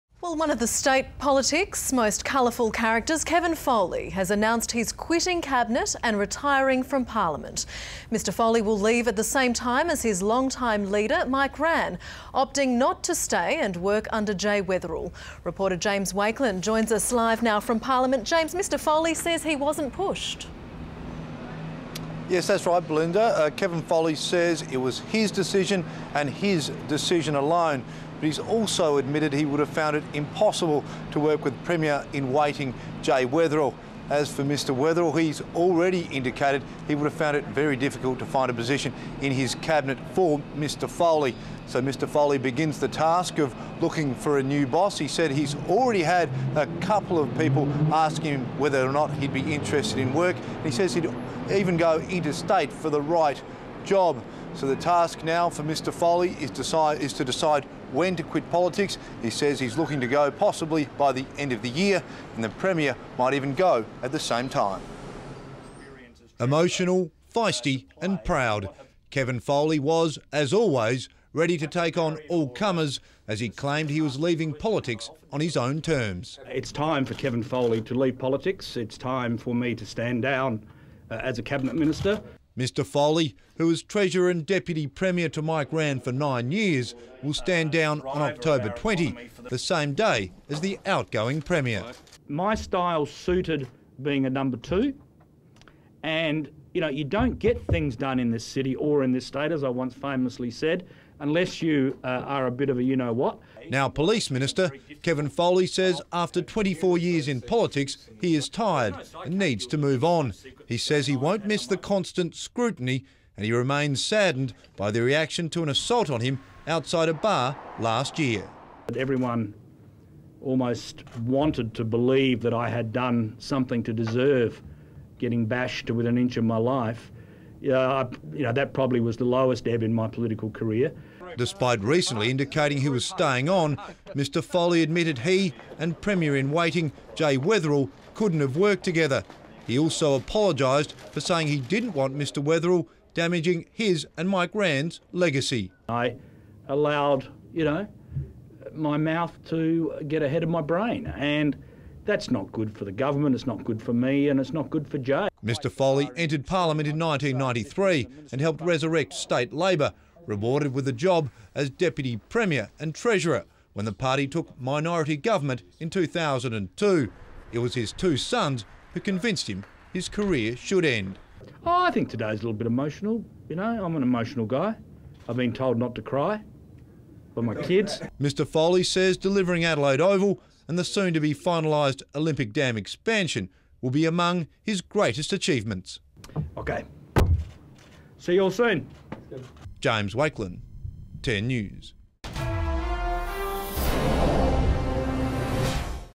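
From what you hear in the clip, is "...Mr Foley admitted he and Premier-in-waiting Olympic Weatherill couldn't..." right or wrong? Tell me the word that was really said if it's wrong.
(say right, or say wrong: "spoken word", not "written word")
wrong: "Jay", not "Olympic".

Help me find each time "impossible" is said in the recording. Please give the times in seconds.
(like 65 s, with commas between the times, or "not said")
30 s.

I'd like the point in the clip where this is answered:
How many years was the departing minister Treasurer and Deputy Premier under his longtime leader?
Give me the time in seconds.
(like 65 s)
86 s.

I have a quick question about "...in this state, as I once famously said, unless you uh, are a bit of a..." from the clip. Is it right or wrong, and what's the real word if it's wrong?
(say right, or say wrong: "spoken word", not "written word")
right.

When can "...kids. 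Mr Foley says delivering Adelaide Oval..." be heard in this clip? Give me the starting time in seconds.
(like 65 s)
177 s.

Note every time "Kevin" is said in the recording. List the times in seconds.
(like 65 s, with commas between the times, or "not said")
3 s, 23 s, 69 s, 77 s, 105 s.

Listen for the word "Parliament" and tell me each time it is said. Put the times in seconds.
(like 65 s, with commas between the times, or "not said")
7 s, 17 s, 156 s.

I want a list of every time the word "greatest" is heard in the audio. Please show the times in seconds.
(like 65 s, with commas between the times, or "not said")
184 s.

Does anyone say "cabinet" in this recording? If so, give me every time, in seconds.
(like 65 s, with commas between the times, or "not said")
5 s, 39 s, 81 s.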